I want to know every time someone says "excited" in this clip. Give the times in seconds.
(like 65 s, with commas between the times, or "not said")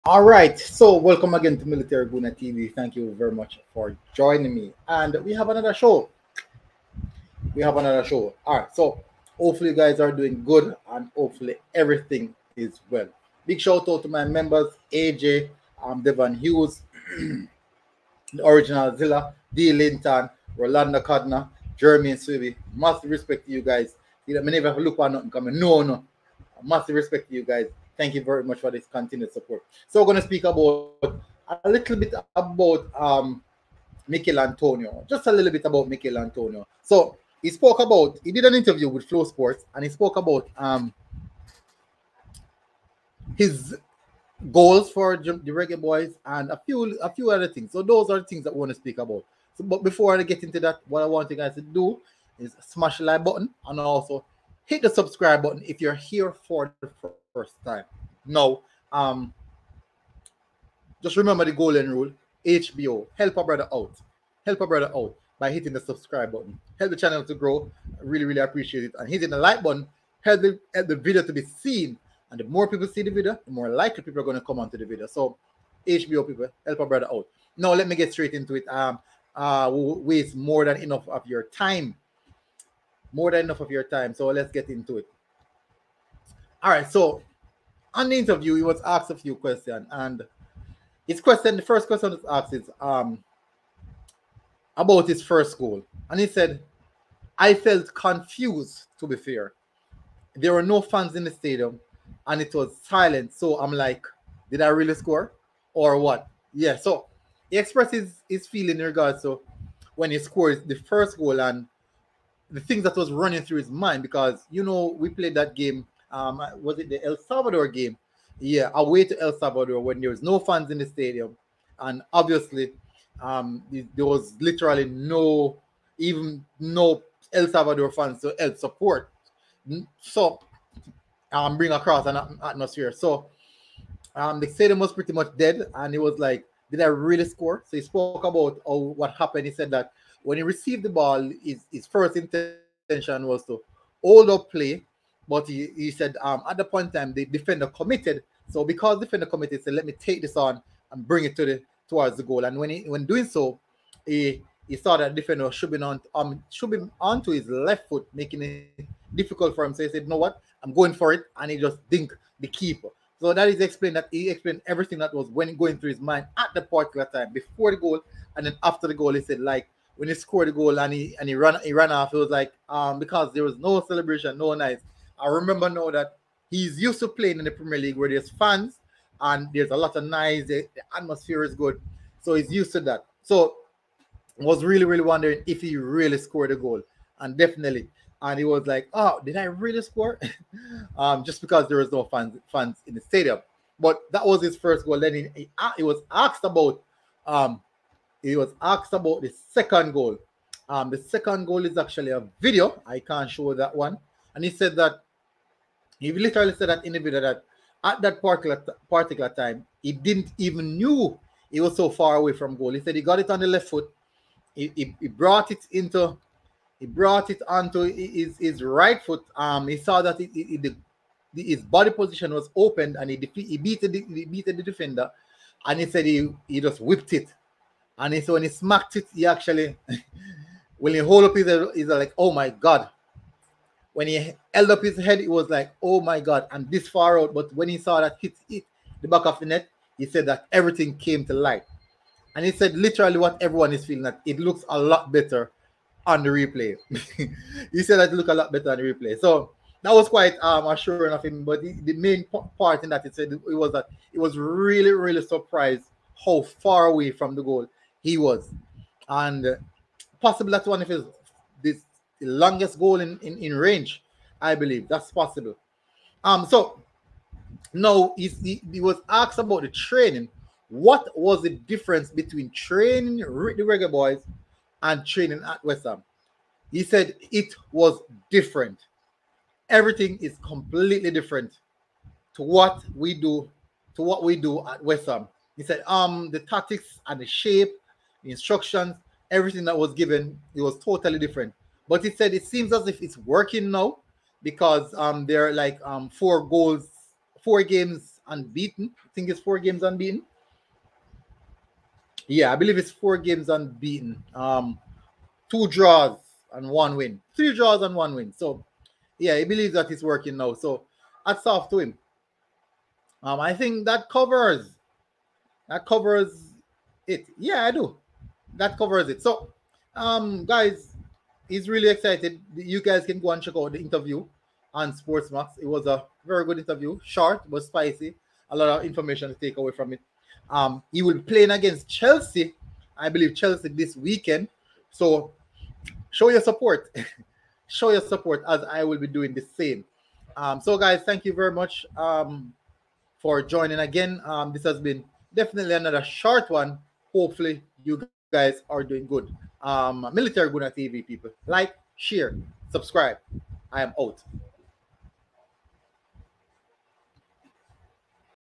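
321 s.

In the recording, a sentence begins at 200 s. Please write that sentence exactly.
Um, the second goal is actually a video.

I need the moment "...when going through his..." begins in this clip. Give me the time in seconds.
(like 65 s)
165 s.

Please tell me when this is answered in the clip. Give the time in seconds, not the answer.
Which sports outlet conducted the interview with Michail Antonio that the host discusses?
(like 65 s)
39 s.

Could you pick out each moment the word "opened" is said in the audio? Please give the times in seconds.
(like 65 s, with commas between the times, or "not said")
222 s.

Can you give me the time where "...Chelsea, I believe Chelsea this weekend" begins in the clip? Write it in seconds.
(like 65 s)
331 s.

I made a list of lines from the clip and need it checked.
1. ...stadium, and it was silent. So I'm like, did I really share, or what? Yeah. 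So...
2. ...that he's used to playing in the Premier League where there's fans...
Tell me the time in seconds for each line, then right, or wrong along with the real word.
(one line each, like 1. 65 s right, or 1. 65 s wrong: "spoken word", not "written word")
1. 101 s wrong: "score", not "share"
2. 175 s right.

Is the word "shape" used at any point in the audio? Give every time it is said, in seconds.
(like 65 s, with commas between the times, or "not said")
287 s.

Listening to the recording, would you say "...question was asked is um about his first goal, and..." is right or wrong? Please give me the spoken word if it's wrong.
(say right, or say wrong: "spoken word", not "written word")
right.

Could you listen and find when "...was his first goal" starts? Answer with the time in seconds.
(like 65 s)
194 s.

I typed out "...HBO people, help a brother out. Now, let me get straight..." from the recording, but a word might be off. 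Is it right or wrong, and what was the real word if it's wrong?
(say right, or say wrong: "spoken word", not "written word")
right.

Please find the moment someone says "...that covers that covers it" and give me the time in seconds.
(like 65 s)
313 s.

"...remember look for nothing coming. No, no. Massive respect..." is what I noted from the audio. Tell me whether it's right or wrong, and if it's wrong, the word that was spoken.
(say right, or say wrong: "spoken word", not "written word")
wrong: "never", not "remember".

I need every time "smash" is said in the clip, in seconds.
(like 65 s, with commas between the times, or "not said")
52 s.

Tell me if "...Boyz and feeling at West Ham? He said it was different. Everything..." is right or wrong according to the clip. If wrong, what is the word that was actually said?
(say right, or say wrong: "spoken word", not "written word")
wrong: "training", not "feeling".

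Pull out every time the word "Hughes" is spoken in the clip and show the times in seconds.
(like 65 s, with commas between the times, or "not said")
16 s.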